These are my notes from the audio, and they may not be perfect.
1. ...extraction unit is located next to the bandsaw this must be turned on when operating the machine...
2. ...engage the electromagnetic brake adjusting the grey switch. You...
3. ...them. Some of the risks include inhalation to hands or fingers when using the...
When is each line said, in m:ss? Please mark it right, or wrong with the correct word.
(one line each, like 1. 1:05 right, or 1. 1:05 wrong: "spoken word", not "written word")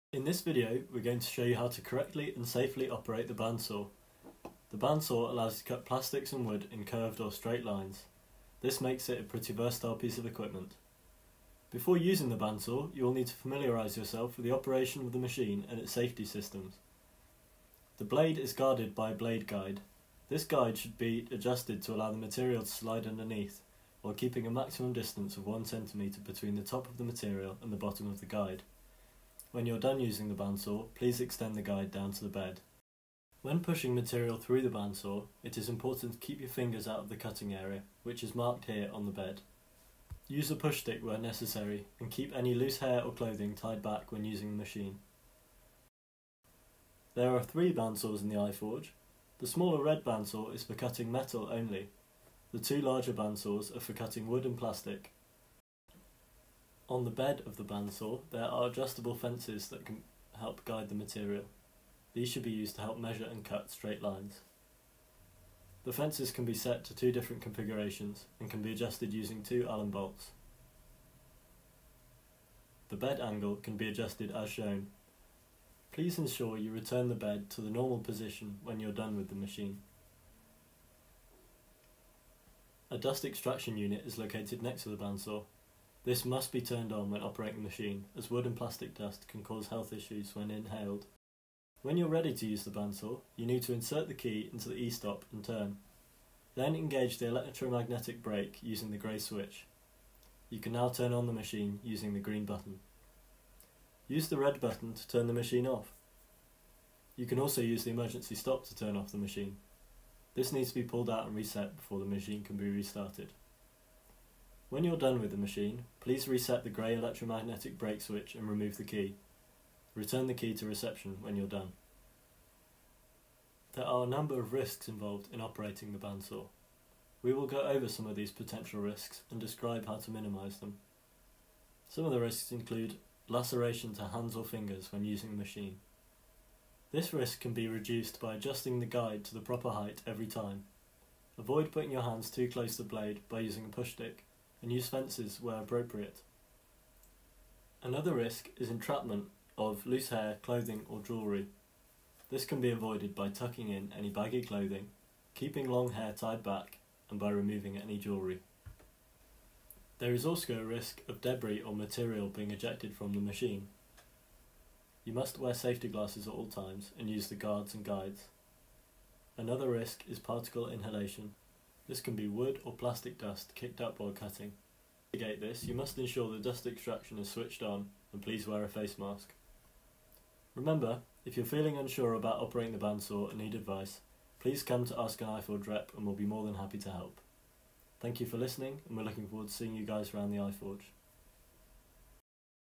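1. 1:23 right
2. 1:36 wrong: "using", not "adjusting"
3. 2:10 wrong: "laceration", not "inhalation".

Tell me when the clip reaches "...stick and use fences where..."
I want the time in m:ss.
2:23.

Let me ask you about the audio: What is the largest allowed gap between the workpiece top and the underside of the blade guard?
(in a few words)
1cm.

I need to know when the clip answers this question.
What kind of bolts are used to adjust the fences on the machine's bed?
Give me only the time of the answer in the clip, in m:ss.
1:09.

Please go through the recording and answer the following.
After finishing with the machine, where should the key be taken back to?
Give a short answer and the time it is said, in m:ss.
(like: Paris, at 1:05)
Reception, at 2:00.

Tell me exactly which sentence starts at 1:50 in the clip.
This needs to be pulled out and reset before the machine can be restarted.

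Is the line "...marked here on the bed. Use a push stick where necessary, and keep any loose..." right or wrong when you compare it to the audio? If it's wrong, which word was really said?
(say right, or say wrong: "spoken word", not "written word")
right.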